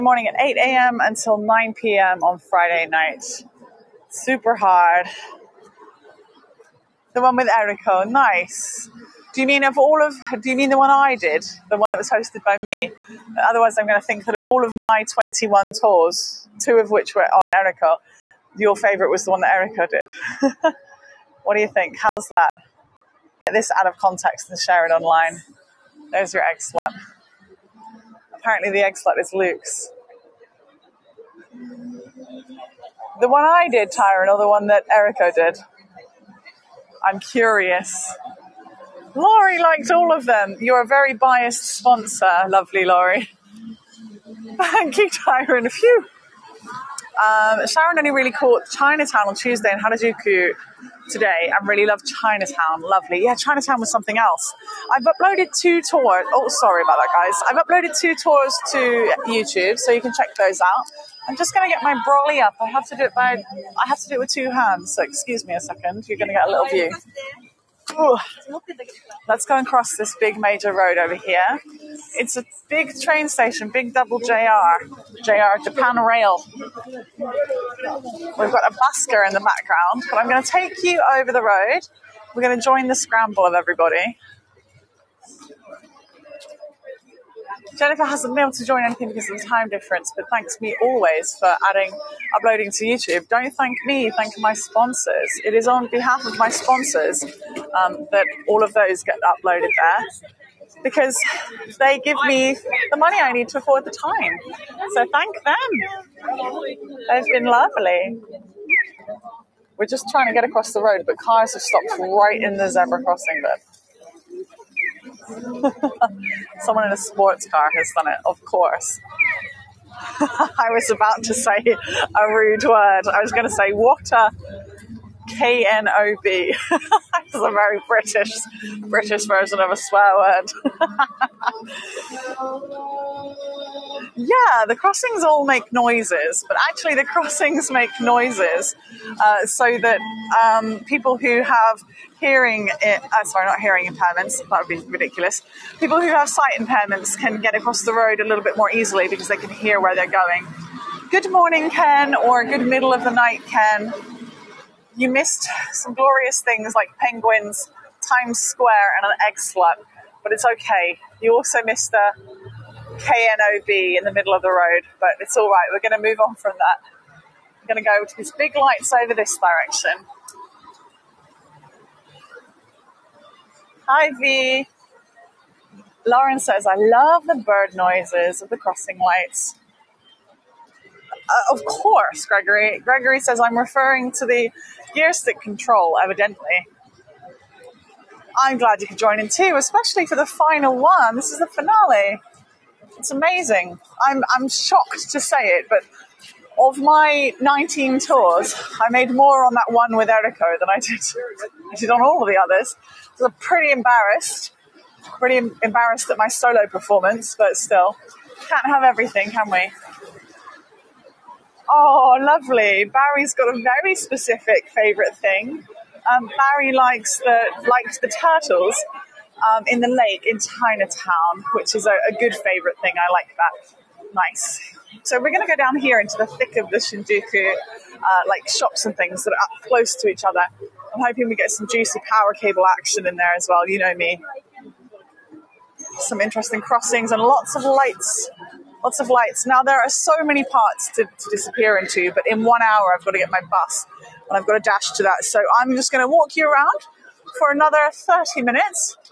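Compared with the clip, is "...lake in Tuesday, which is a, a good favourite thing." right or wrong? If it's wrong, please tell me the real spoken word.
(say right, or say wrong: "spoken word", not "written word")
wrong: "Chinatown", not "Tuesday".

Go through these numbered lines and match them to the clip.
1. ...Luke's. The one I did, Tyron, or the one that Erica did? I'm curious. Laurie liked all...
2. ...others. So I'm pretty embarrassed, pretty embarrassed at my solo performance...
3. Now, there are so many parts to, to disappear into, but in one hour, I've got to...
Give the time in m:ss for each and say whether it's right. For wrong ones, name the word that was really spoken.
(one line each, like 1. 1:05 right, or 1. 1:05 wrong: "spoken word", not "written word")
1. 0:29 right
2. 3:22 right
3. 3:59 right.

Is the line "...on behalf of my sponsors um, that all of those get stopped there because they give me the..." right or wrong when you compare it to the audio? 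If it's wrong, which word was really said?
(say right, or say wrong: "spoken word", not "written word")
wrong: "uploaded", not "stopped".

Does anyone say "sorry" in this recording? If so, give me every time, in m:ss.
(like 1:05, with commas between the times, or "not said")
0:56, 2:23.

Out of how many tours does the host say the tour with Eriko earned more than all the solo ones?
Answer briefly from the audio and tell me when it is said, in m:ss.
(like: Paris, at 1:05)
19, at 3:17.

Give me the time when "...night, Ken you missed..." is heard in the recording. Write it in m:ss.
2:33.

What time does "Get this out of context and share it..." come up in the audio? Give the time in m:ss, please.
0:23.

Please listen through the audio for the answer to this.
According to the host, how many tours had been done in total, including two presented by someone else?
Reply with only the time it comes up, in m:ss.
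0:15.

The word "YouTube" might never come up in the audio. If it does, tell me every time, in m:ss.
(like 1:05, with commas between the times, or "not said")
0:59, 1:32.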